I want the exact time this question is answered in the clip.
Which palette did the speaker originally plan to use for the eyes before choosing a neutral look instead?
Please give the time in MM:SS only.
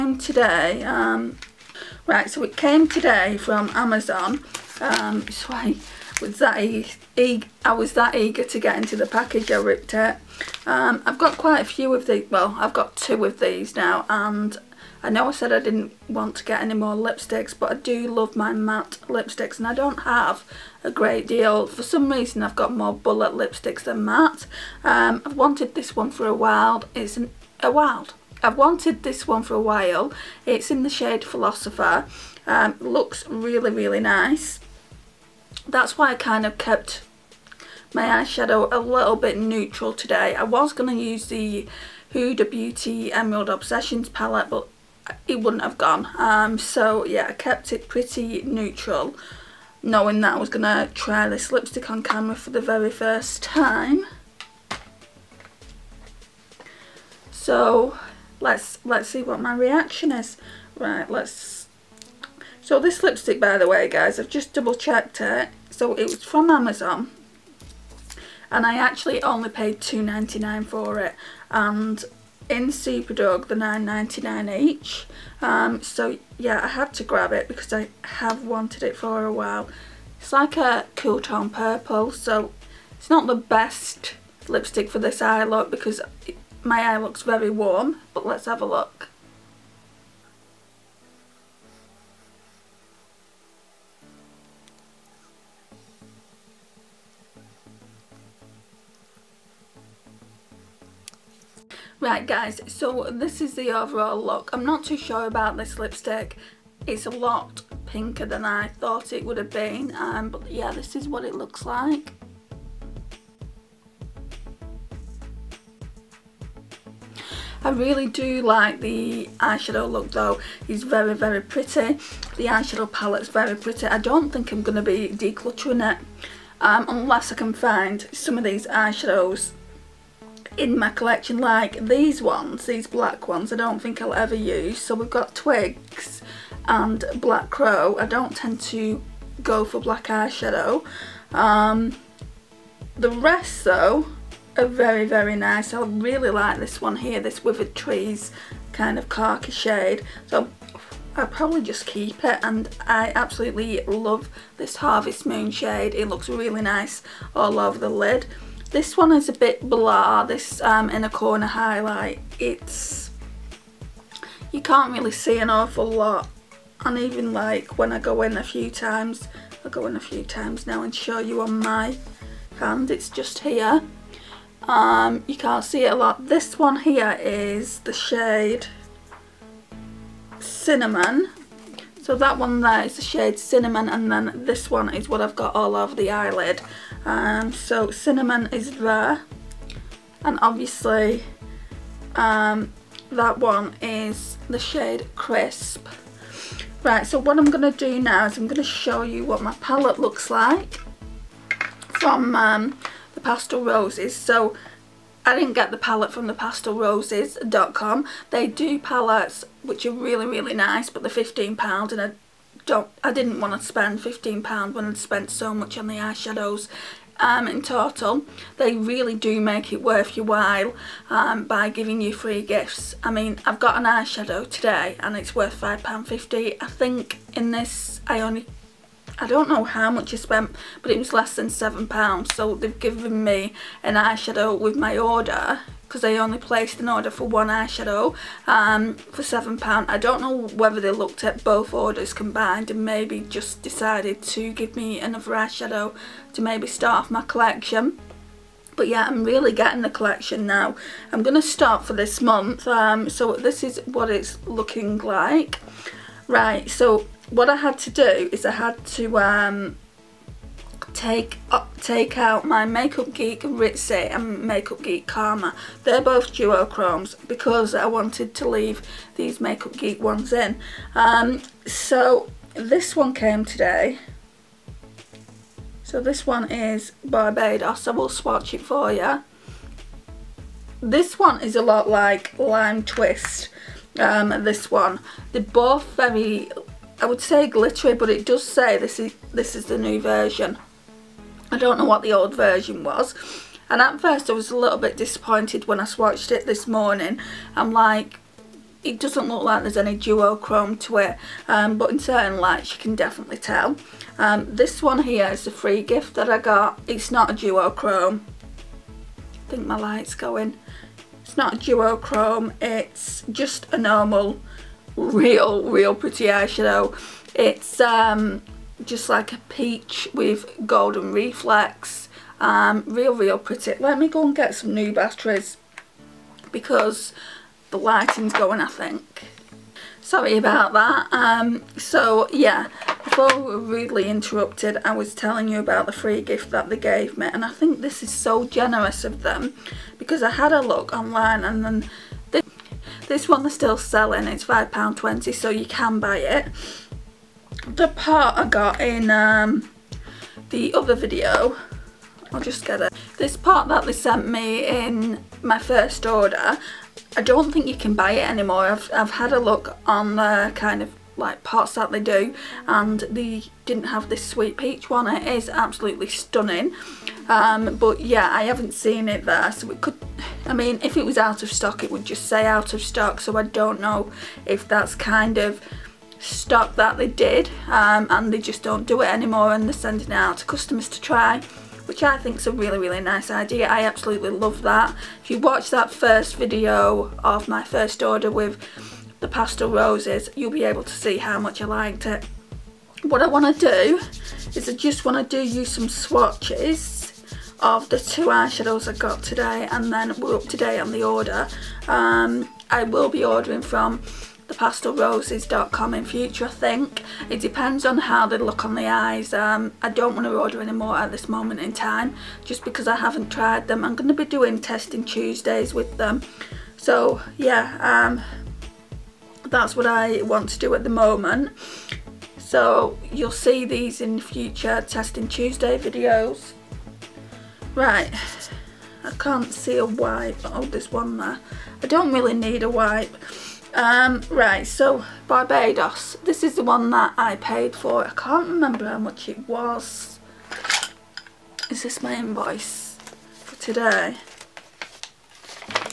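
00:42.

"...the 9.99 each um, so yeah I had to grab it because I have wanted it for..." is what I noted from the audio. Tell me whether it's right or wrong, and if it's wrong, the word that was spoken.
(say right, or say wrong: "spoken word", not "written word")
right.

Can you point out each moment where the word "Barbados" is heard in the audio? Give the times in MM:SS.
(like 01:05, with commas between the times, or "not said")
04:37, 07:15.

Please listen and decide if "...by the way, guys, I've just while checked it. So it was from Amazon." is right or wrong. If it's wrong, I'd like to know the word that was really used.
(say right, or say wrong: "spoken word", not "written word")
wrong: "double", not "while".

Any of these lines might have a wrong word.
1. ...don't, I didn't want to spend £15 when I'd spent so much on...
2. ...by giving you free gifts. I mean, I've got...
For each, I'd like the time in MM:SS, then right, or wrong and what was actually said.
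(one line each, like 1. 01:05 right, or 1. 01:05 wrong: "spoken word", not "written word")
1. 03:32 right
2. 03:41 right.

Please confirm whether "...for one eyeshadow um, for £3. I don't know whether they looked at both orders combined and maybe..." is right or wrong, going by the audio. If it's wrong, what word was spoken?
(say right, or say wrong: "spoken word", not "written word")
wrong: "7", not "3".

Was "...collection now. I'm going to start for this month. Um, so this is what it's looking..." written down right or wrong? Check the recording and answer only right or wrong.
right.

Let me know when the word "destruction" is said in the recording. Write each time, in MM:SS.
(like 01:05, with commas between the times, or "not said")
not said.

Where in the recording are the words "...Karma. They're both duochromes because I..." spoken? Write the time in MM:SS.
04:25.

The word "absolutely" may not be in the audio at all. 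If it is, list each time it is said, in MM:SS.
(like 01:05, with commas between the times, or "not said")
02:33, 06:05, 06:23.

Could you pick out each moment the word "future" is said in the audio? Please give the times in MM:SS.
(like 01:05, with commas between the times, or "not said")
06:46, 07:04.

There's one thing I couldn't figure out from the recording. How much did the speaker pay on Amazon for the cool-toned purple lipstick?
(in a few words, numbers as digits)
2.99.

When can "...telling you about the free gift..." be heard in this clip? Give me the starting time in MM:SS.
05:35.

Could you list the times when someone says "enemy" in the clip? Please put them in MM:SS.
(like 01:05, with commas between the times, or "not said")
not said.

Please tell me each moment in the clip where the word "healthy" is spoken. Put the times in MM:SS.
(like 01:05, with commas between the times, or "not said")
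not said.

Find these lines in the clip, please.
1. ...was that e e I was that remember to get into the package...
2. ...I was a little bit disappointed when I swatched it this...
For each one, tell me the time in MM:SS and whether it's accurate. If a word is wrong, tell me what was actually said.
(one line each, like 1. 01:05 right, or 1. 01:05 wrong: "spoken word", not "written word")
1. 00:06 wrong: "eager", not "remember"
2. 04:54 right.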